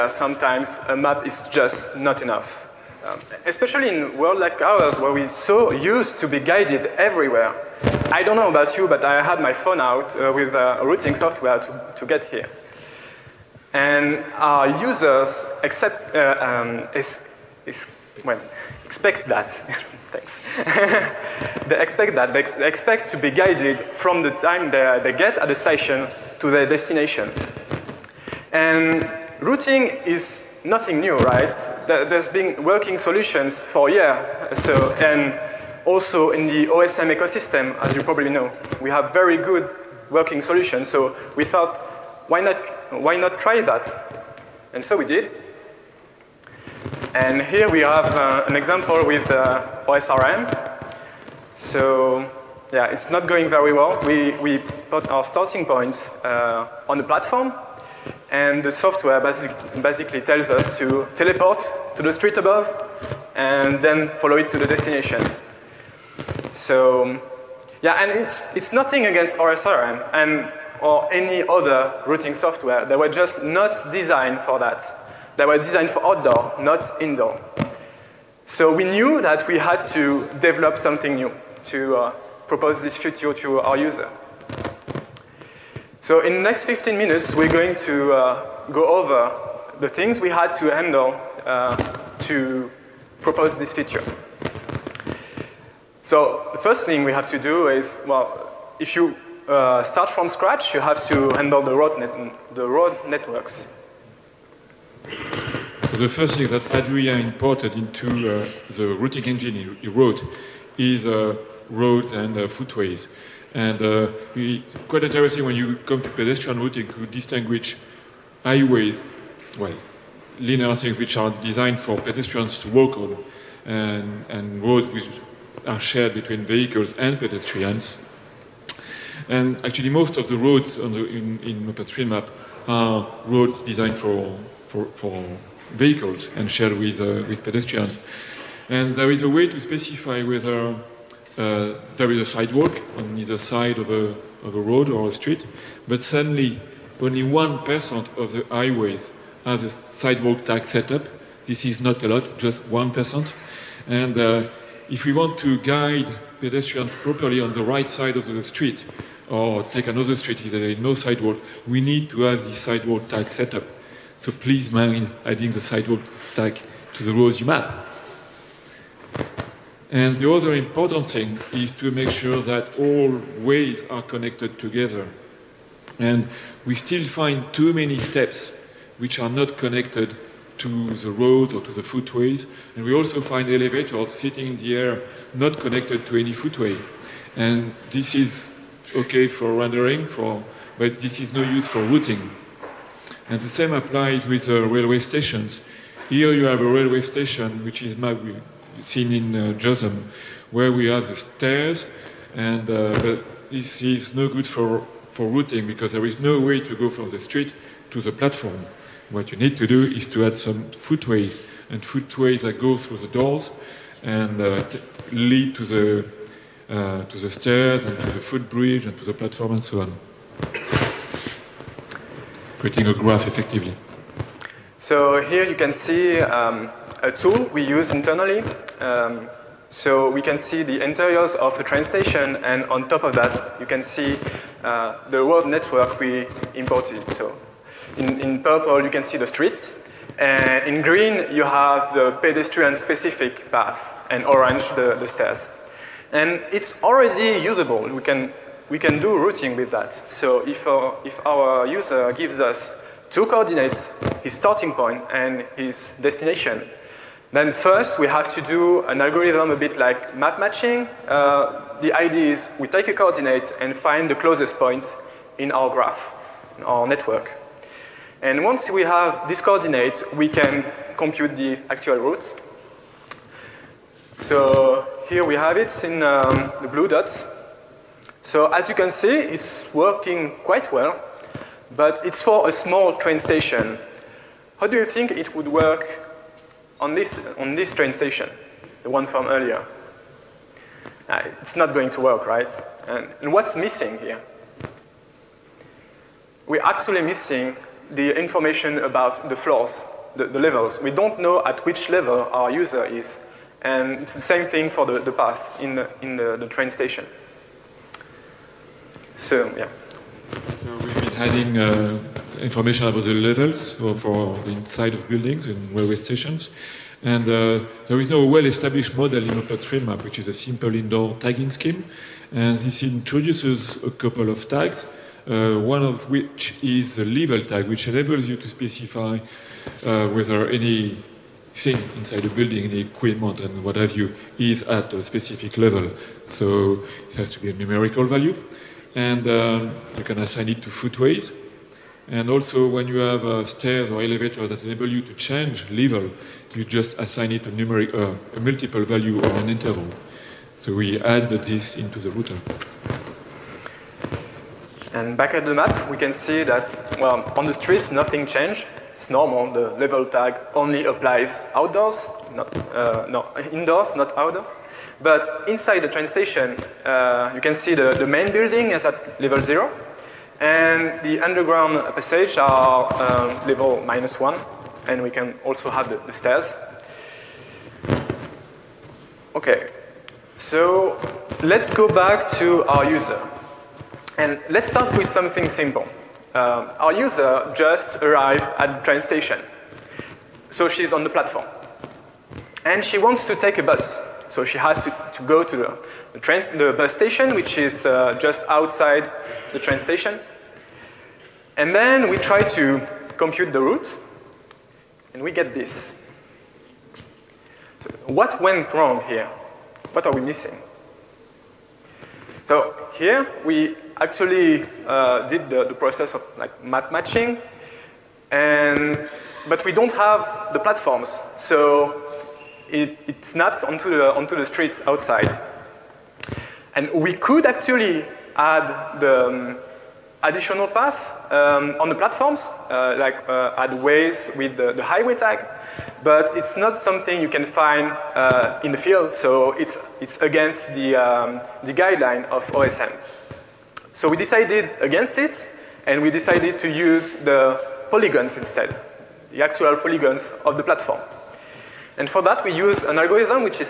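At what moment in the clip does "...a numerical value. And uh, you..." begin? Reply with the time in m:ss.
5:37.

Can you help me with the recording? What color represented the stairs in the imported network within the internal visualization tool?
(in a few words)
orange.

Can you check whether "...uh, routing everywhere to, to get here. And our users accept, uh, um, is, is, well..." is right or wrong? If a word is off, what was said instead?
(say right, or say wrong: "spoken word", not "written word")
wrong: "software", not "everywhere".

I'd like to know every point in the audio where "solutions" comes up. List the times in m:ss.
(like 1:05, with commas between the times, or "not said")
0:32, 0:40.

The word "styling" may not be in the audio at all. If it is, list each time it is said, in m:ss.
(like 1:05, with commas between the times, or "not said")
not said.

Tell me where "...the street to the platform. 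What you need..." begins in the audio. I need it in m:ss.
3:27.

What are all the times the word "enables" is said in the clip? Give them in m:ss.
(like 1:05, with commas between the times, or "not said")
5:27, 5:44.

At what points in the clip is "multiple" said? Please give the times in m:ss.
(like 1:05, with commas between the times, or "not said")
5:48.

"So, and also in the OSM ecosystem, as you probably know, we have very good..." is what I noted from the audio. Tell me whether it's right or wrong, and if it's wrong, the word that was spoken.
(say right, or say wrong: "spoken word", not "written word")
right.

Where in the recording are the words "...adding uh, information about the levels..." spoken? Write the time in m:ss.
5:11.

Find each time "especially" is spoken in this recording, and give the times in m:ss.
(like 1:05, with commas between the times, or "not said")
0:03.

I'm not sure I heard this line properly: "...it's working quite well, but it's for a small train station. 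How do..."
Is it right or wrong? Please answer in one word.
right.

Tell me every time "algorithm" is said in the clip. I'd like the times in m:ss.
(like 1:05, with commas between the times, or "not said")
4:19, 7:32.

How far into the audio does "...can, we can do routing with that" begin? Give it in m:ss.
4:08.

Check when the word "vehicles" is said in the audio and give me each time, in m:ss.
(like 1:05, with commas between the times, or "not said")
2:06, 2:15.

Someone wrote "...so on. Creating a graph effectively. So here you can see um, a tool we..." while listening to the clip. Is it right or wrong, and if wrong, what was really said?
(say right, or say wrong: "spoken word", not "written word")
right.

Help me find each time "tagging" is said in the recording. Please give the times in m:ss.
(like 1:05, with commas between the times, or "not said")
5:21.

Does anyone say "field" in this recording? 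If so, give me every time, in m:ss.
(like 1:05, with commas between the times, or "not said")
7:18.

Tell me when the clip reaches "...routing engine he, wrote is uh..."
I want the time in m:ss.
1:48.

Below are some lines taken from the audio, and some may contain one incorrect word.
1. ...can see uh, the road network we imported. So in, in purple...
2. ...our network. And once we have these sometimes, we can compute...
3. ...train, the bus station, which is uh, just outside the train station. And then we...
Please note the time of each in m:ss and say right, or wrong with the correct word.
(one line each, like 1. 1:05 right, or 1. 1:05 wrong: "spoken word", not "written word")
1. 3:53 right
2. 4:26 wrong: "coordinates", not "sometimes"
3. 6:36 right.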